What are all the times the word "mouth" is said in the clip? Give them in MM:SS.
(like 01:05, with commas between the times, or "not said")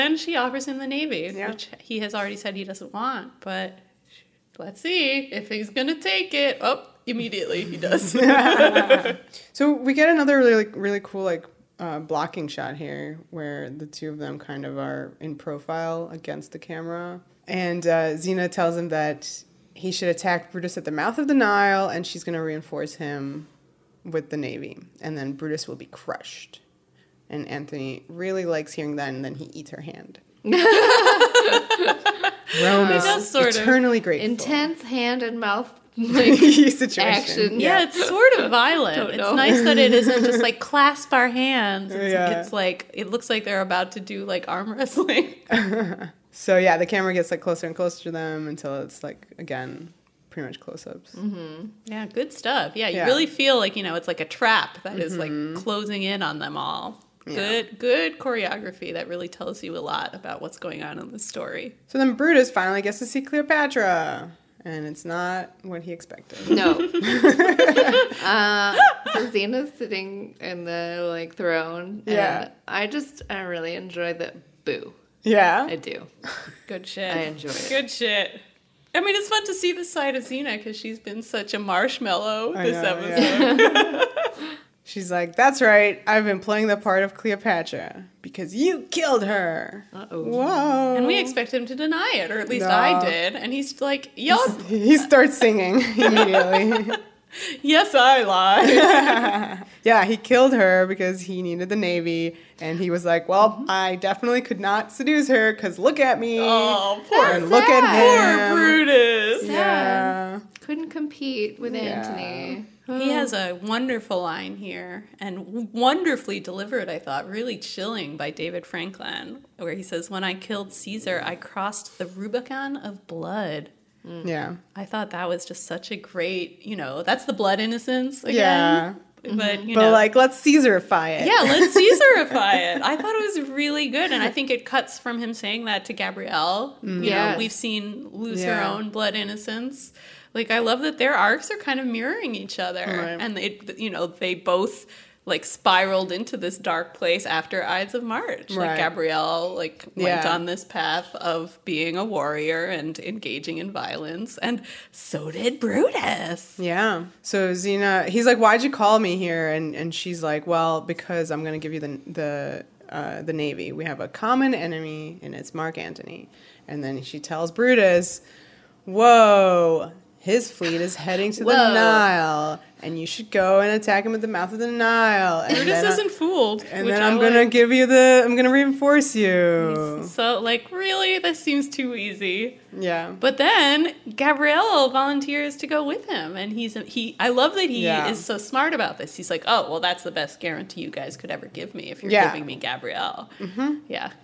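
00:20, 00:35, 02:54.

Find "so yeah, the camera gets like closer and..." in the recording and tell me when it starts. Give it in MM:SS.
00:46.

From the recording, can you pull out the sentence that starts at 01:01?
So then Brutus finally gets to see Cleopatra and it's not what he expected.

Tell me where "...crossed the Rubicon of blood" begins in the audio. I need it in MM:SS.
02:01.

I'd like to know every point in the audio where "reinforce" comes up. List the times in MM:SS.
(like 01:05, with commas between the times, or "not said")
00:22, 02:58.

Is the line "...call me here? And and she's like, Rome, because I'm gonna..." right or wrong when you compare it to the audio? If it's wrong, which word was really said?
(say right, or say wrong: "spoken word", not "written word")
wrong: "Well", not "Rome".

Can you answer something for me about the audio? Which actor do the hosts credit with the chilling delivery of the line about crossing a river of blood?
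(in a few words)
David Franklin.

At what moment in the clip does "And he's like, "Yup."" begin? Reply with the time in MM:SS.
01:33.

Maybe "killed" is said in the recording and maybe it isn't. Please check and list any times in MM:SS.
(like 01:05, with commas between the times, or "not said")
01:28, 01:40, 02:00.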